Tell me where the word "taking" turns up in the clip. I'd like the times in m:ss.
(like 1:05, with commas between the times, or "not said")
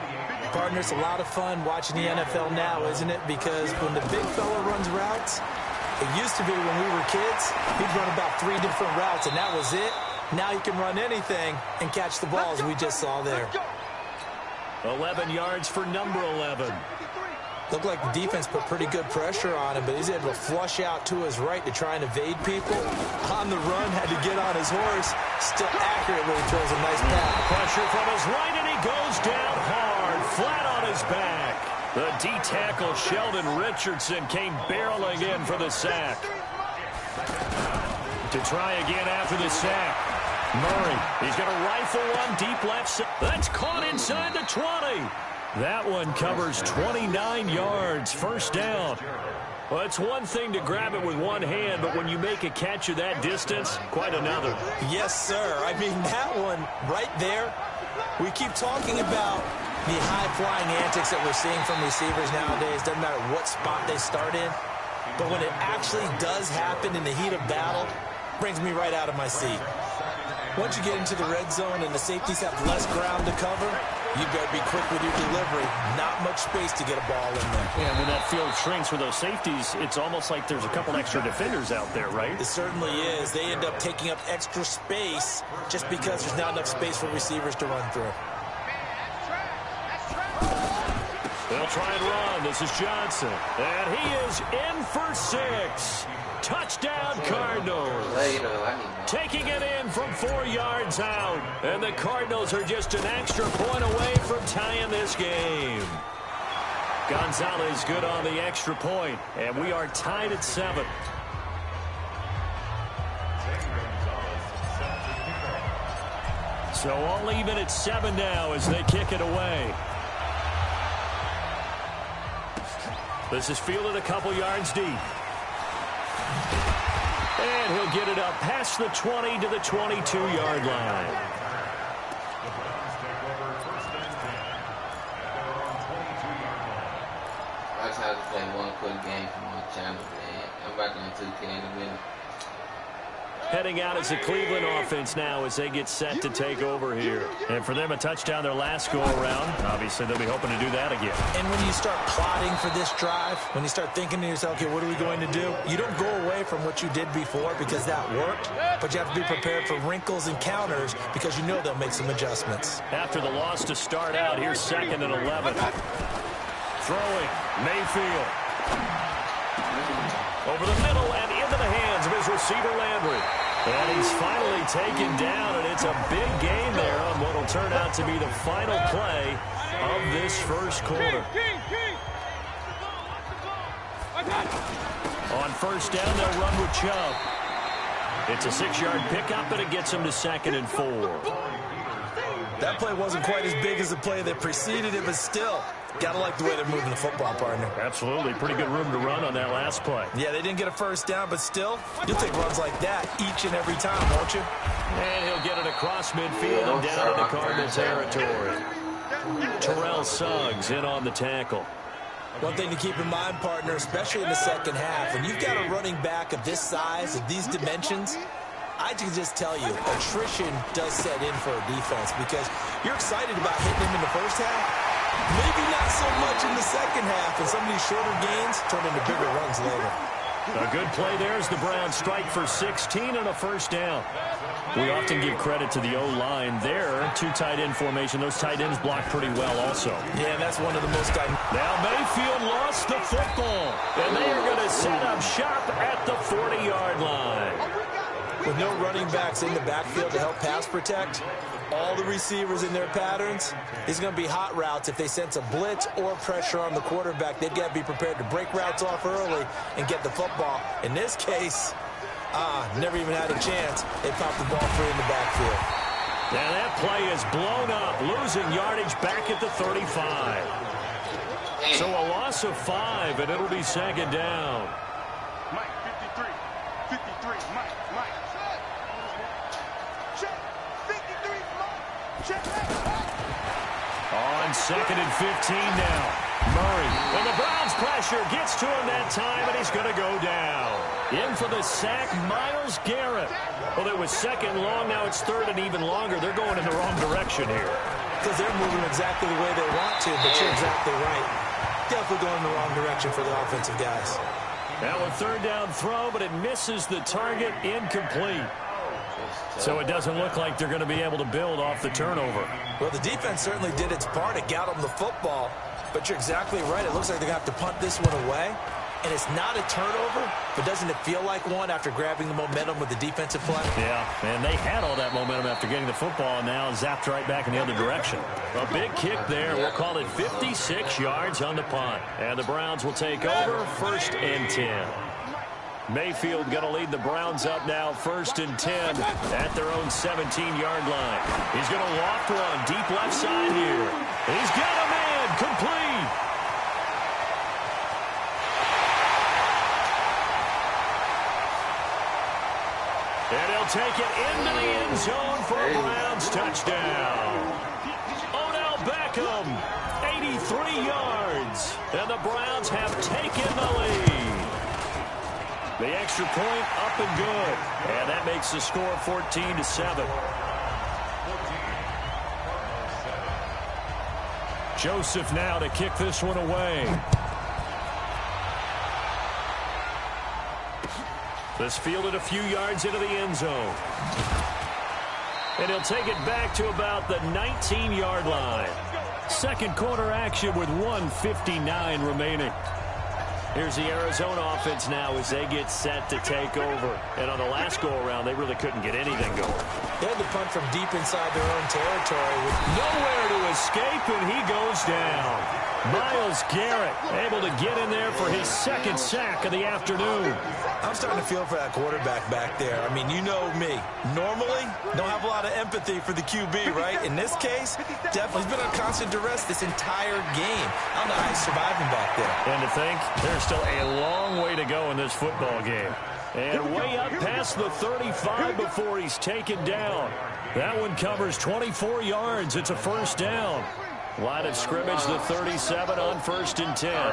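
1:23, 1:39.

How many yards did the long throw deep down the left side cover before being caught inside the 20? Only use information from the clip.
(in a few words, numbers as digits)
29.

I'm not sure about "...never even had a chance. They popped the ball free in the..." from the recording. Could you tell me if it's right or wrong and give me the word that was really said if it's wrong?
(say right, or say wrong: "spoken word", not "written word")
right.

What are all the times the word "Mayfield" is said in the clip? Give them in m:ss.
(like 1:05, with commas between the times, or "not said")
2:47, 4:01, 5:35.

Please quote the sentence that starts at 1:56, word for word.
So all even at seven now as they kick it away.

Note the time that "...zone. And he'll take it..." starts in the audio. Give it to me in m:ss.
6:23.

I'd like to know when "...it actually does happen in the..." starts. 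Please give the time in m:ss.
1:05.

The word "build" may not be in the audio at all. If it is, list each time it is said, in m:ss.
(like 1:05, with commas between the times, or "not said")
5:11.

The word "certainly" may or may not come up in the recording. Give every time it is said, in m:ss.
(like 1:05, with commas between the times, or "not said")
1:22, 5:13.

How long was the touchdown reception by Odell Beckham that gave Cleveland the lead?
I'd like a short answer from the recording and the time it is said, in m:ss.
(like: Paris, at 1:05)
83 yards, at 6:00.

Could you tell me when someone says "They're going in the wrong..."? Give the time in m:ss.
4:56.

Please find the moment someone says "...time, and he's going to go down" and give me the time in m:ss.
4:49.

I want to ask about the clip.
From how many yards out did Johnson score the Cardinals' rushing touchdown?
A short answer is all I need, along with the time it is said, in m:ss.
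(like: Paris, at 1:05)
4, at 1:40.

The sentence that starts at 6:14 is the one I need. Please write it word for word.
Joseph now to kick this one away.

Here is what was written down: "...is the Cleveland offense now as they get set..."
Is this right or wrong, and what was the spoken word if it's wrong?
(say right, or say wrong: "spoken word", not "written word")
right.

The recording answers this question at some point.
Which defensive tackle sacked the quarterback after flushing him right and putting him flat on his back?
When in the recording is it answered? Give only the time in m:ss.
0:32.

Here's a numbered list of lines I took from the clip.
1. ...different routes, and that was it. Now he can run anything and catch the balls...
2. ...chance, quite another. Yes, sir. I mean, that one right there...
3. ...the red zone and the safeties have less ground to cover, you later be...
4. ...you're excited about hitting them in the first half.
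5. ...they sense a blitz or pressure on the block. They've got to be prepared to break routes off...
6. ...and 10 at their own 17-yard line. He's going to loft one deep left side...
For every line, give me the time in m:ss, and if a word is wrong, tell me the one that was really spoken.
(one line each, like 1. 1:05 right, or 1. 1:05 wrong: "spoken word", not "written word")
1. 0:08 right
2. 0:53 wrong: "distance", not "chance"
3. 1:11 wrong: "better", not "later"
4. 3:42 right
5. 4:14 wrong: "quarterback", not "block"
6. 5:38 right.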